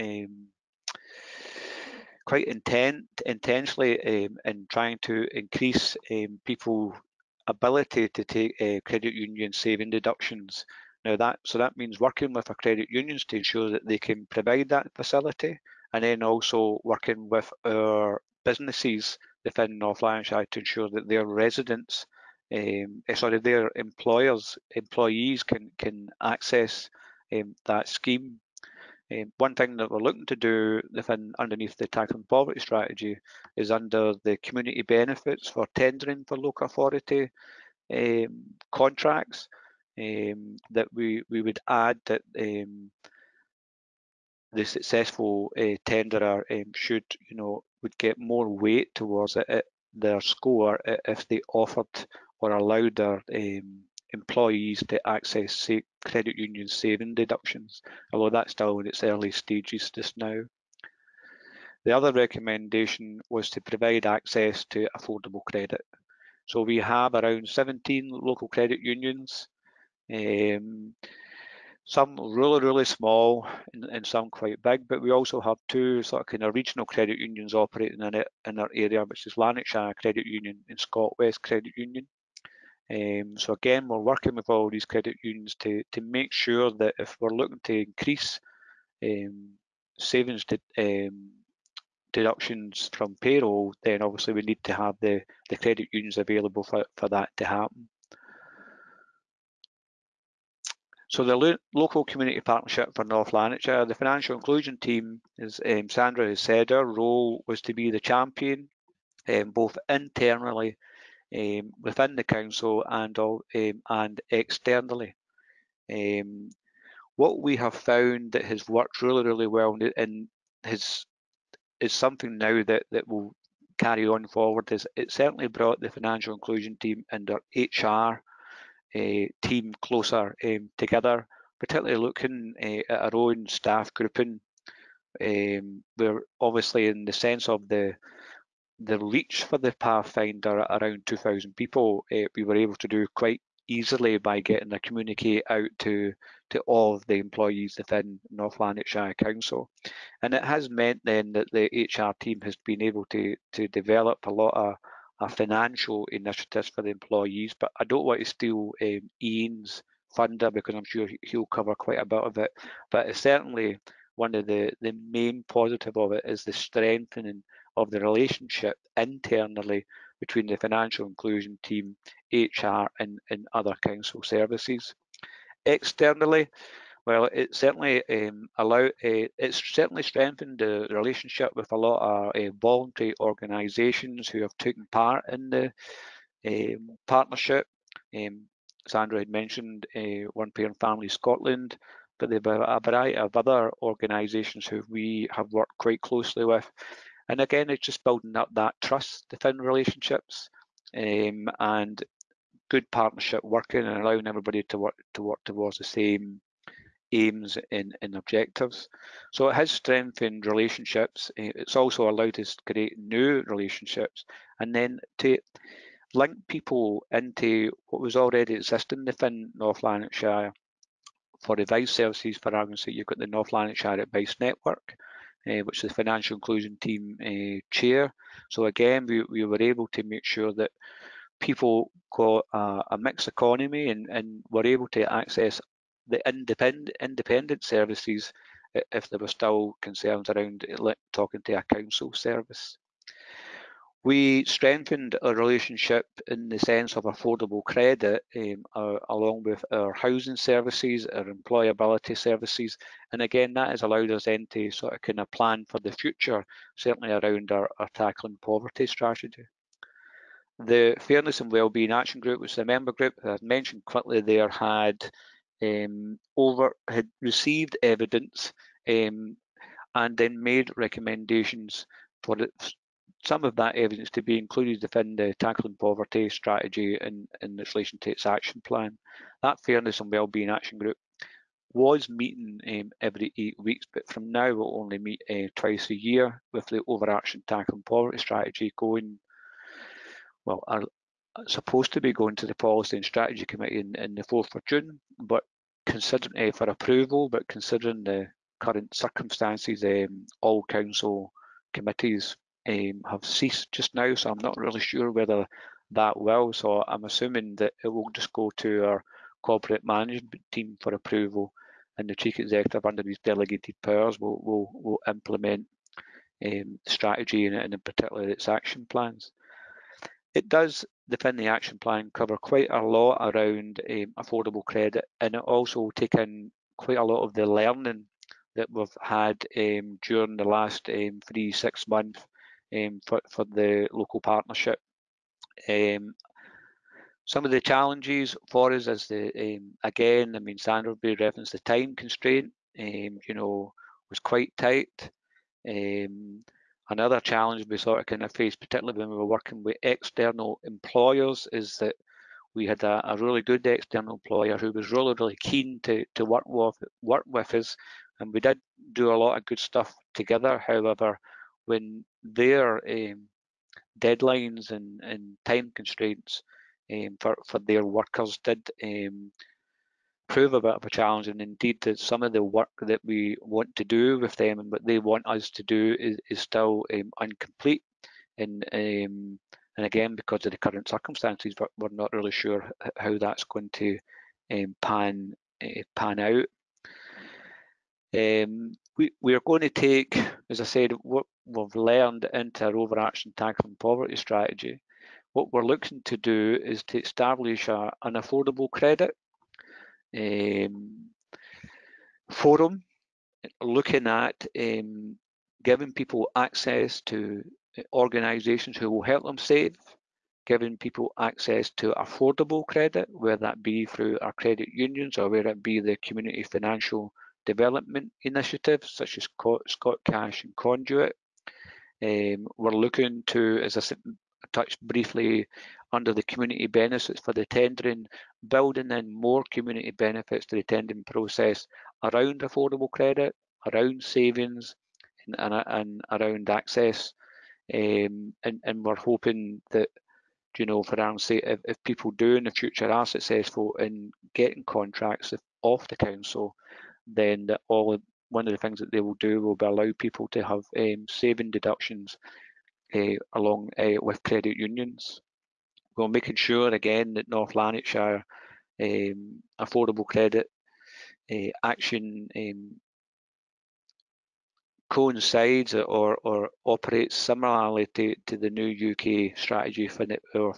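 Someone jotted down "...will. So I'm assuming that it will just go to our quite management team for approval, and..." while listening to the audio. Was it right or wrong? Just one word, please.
wrong.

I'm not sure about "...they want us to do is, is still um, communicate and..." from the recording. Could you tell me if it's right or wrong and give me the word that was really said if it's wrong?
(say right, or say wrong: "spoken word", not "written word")
wrong: "incomplete", not "communicate".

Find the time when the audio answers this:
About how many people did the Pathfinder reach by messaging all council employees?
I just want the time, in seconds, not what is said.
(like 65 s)
141 s.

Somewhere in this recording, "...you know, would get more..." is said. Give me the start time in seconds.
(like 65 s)
47 s.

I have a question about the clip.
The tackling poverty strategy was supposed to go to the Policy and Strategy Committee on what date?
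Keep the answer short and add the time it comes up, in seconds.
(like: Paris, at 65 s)
4th of June, at 294 s.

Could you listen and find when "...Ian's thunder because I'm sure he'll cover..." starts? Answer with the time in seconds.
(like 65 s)
159 s.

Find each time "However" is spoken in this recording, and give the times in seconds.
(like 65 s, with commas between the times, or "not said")
360 s.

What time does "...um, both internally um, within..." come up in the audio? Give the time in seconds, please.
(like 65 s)
109 s.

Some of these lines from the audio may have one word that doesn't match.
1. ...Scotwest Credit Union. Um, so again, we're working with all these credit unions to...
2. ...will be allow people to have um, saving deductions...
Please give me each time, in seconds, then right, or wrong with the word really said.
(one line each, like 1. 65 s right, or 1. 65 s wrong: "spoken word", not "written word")
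1. 80 s right
2. 449 s right.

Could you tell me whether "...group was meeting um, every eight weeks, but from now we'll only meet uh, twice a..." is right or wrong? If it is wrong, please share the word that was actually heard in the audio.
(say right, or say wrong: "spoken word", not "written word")
right.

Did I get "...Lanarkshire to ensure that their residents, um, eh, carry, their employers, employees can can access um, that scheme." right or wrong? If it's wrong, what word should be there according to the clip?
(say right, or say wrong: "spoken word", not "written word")
wrong: "sorry", not "carry".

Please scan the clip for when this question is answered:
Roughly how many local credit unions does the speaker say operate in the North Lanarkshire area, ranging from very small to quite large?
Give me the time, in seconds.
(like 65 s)
67 s.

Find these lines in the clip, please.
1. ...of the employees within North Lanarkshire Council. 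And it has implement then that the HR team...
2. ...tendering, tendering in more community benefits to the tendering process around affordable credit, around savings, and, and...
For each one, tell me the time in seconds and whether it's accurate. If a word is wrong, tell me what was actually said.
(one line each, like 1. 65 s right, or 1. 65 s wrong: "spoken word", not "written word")
1. 146 s wrong: "meant", not "implement"
2. 427 s wrong: "building", not "tendering".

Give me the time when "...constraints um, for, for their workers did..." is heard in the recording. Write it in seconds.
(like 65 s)
365 s.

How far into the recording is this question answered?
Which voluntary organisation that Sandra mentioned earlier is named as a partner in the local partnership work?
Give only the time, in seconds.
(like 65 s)
190 s.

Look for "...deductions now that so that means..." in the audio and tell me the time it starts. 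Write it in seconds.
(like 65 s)
9 s.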